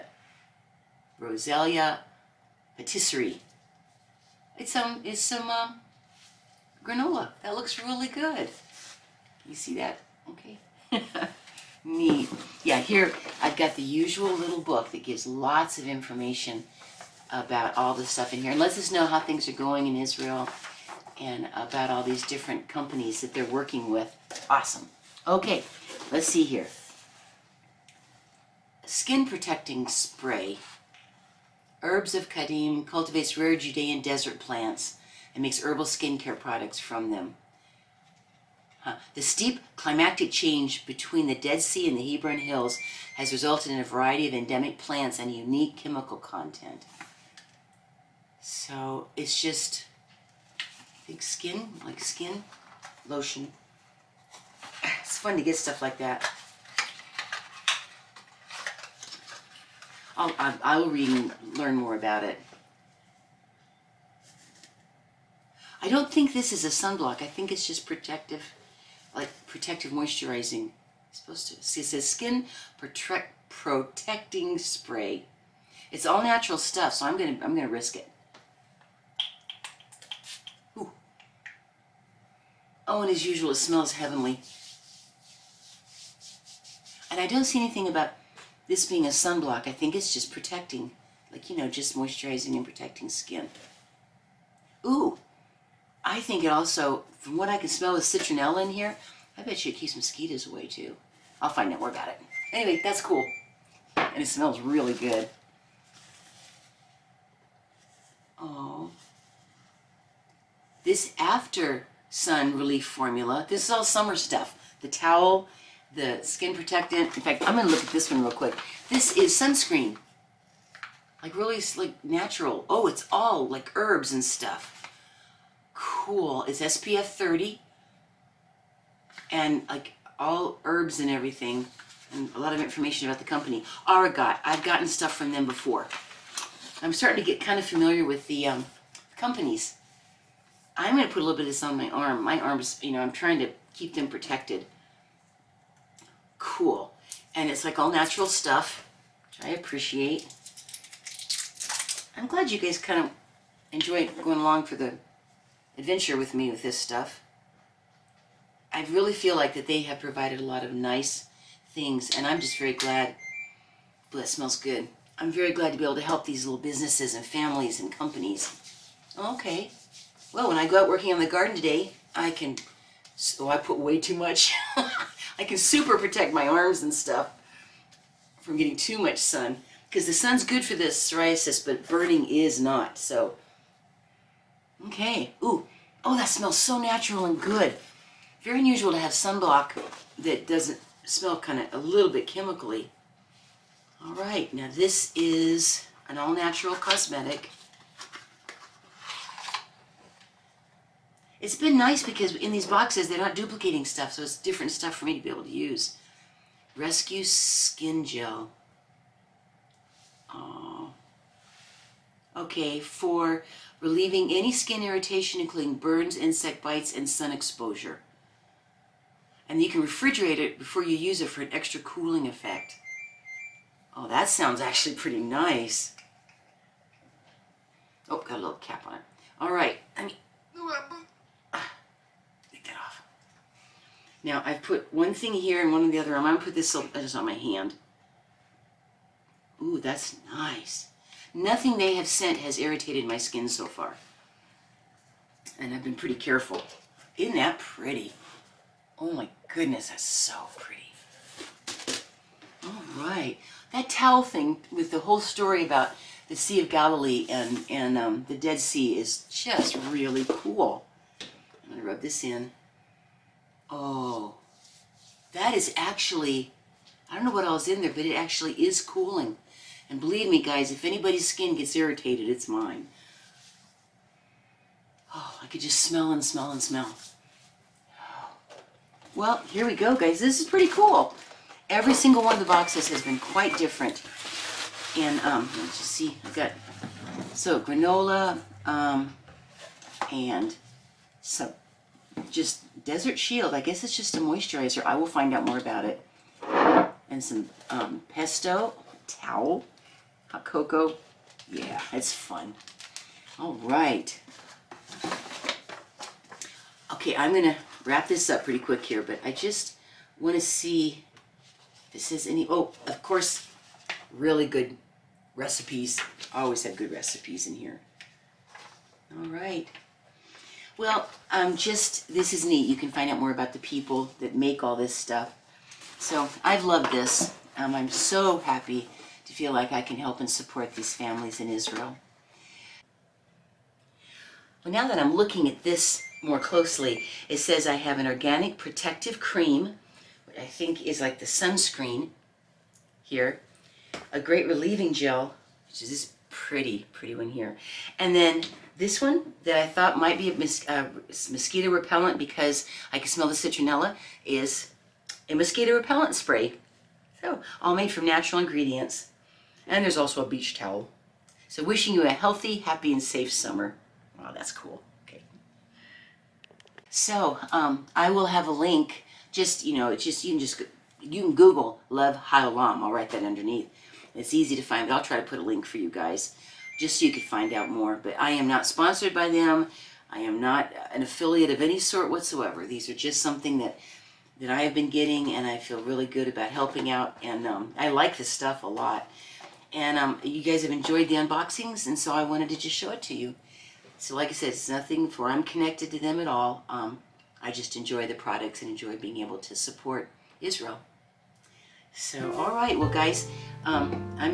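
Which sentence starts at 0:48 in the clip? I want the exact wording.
So it's just Big skin, like skin lotion.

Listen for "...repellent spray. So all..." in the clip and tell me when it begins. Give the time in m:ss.
5:55.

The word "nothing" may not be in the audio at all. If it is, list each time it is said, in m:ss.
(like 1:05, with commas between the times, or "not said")
4:01, 6:34.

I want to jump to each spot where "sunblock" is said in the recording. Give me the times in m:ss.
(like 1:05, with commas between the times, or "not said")
1:06, 1:29, 3:09.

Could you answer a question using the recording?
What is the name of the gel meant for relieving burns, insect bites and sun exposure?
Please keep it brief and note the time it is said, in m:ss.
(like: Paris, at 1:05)
Rescue Skin Gel, at 3:26.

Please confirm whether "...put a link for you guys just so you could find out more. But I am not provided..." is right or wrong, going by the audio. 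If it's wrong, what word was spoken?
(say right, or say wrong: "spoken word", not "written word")
wrong: "sponsored", not "provided".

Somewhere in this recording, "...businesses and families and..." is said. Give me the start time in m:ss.
2:46.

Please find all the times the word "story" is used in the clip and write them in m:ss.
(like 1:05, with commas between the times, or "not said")
4:15.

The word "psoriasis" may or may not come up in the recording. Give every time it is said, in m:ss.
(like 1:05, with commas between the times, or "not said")
3:01.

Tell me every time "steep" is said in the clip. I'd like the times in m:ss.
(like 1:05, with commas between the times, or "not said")
0:39.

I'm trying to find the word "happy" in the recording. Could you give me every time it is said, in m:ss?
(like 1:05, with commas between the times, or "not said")
5:28, 6:02.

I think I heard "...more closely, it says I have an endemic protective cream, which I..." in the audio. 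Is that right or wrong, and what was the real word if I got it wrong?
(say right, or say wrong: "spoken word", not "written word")
wrong: "organic", not "endemic".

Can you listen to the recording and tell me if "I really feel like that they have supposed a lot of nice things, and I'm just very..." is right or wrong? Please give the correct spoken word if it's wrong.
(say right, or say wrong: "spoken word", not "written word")
wrong: "provided", not "supposed".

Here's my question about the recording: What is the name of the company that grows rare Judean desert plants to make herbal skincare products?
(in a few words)
Herbs of Kedem.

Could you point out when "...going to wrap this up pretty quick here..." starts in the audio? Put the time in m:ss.
5:07.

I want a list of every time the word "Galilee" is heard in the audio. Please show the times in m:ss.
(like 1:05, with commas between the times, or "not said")
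4:16.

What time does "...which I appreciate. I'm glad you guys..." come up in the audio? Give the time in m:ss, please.
2:29.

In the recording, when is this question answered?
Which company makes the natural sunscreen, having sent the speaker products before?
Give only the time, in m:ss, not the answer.
2:13.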